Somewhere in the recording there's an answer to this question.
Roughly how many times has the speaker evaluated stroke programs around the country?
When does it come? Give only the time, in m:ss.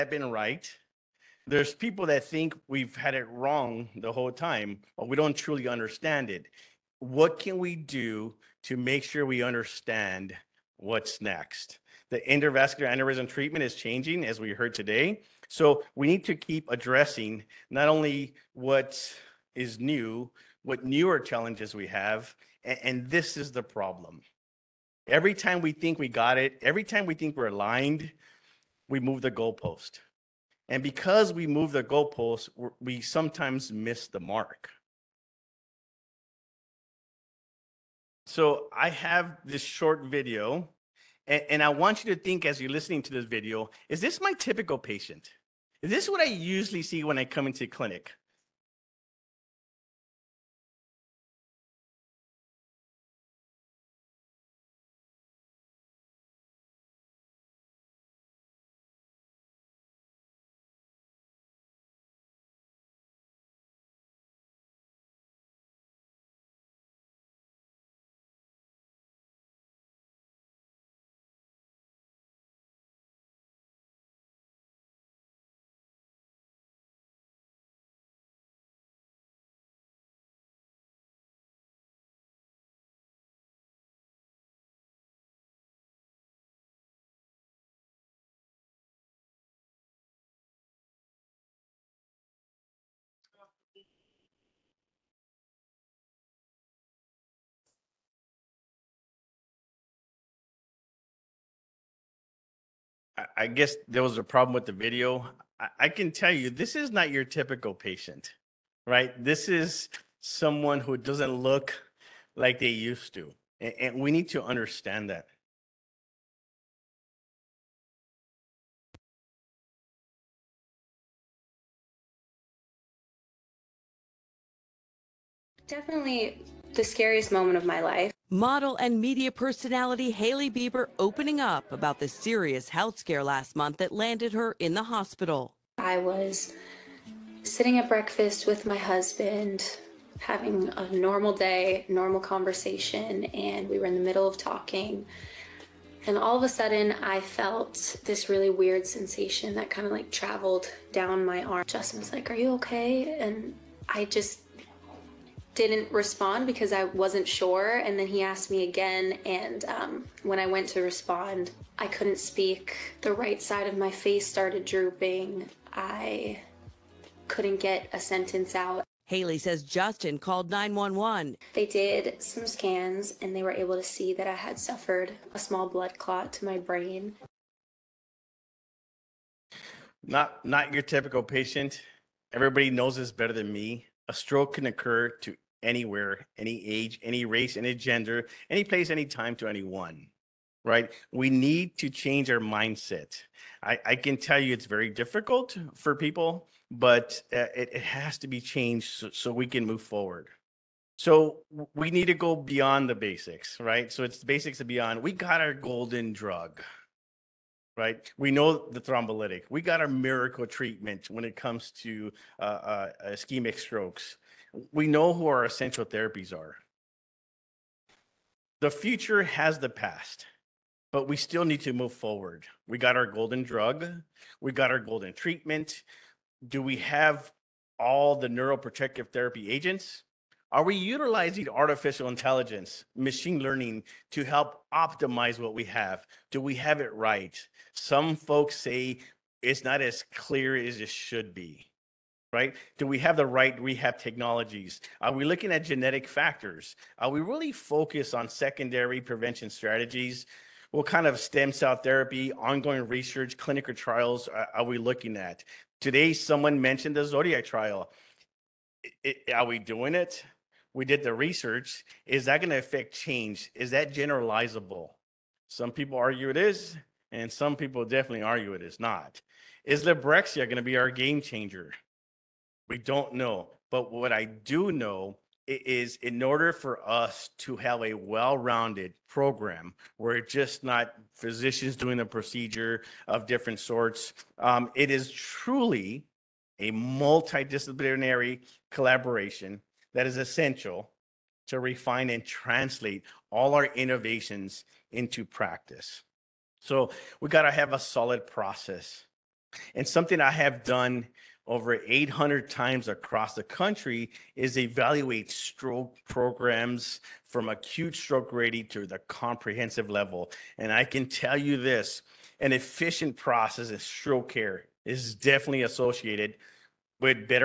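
5:01.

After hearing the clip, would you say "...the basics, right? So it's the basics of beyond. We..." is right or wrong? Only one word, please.
right.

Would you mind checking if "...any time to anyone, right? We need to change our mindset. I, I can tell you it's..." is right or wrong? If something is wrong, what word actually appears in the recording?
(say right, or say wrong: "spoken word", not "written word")
right.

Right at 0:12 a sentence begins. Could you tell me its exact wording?
The endovascular aneurysm treatment is changing, as we heard today.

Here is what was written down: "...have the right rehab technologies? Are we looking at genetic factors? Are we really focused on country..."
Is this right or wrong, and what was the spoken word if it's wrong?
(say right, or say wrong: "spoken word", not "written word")
wrong: "secondary", not "country".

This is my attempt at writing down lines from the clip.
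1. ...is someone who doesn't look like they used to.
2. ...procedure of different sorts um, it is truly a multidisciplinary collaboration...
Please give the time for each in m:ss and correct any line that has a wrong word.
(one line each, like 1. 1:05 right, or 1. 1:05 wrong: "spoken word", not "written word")
1. 1:49 right
2. 4:42 right.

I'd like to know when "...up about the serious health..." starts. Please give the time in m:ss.
2:11.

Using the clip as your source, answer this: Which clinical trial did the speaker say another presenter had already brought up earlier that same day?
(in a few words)
Zodiac trial.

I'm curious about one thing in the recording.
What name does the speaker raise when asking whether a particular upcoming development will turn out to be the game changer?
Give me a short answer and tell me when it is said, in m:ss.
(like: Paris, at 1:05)
Librexia, at 4:29.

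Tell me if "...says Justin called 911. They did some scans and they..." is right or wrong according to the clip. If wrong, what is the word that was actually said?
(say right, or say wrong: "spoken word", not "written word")
right.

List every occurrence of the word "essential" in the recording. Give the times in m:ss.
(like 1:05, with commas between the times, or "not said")
3:35, 4:50.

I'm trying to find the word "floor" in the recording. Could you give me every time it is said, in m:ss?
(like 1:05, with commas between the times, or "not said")
not said.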